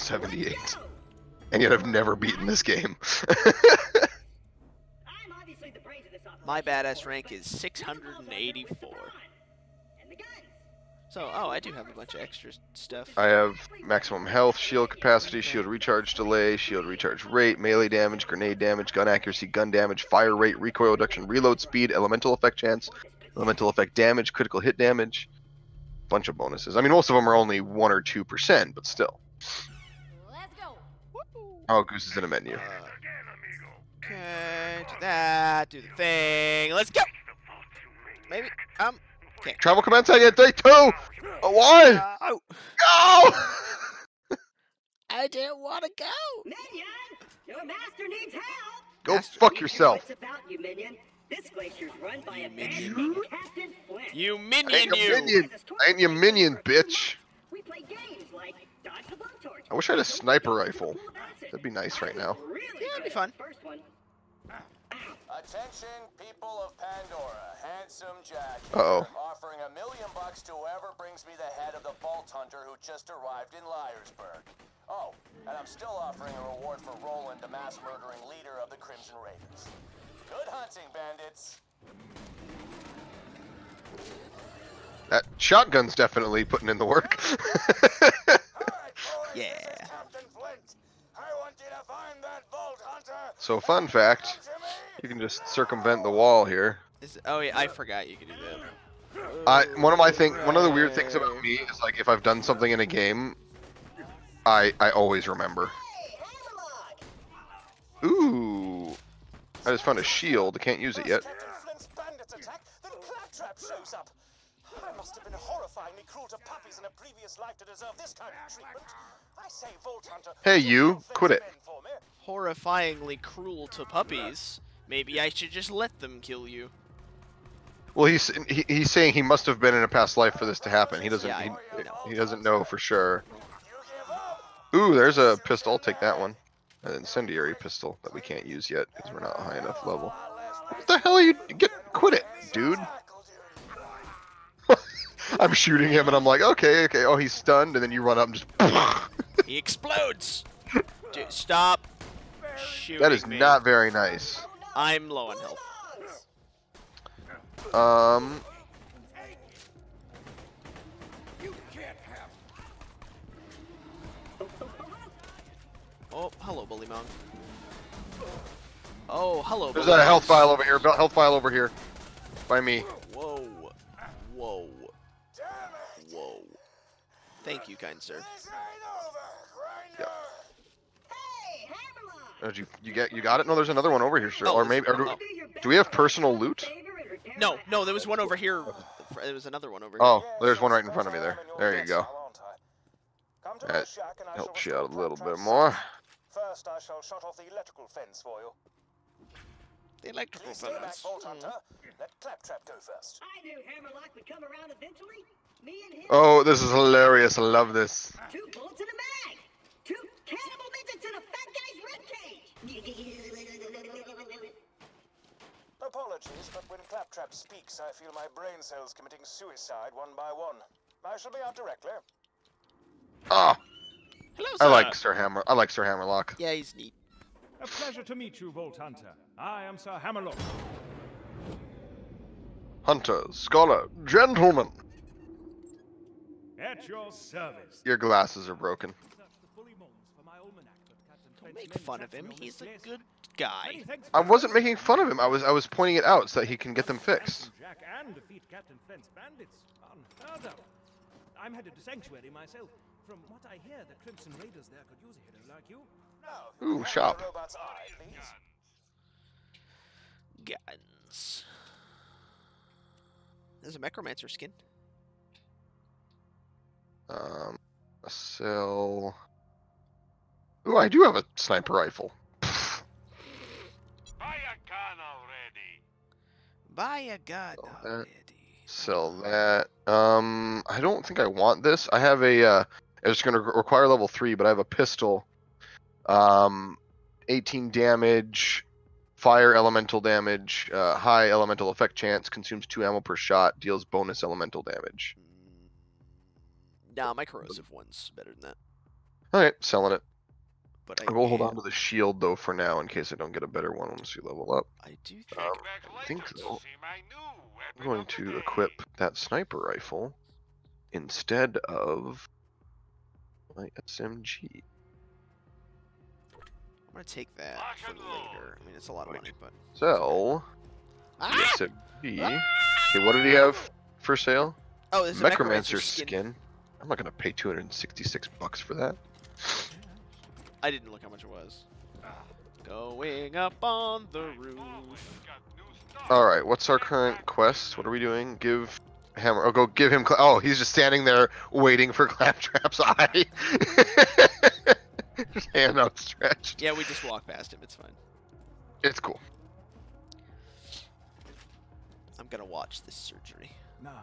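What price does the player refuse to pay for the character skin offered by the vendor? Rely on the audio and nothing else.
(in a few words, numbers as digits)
266 bucks.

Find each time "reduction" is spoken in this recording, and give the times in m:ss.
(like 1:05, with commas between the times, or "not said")
0:20.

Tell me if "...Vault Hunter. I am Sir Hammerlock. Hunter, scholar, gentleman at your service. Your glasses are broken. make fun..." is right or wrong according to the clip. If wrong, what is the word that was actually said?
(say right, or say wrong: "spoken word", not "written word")
right.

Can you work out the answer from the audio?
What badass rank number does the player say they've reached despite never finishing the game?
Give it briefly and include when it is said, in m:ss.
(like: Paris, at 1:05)
684, at 0:07.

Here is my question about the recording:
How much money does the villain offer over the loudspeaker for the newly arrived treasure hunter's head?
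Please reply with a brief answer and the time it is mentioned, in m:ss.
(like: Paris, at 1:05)
a million bucks, at 1:09.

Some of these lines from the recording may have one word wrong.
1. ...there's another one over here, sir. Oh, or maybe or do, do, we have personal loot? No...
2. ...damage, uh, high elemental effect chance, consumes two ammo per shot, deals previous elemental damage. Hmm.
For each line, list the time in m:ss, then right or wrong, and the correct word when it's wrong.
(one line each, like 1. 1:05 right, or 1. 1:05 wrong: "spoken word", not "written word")
1. 3:03 right
2. 4:50 wrong: "bonus", not "previous".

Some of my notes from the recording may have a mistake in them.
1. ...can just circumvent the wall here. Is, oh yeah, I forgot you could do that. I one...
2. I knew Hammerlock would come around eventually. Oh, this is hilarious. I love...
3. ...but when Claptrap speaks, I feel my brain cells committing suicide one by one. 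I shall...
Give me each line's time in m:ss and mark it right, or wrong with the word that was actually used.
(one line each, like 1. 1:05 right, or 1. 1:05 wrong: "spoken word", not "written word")
1. 1:35 right
2. 3:23 right
3. 3:36 right.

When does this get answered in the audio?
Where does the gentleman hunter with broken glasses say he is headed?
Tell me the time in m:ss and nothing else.
4:11.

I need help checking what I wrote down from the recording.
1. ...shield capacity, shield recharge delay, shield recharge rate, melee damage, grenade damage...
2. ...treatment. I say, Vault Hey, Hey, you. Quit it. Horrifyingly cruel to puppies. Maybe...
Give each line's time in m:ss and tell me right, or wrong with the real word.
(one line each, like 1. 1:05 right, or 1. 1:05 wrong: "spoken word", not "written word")
1. 0:14 right
2. 1:58 wrong: "Hunter", not "Hey".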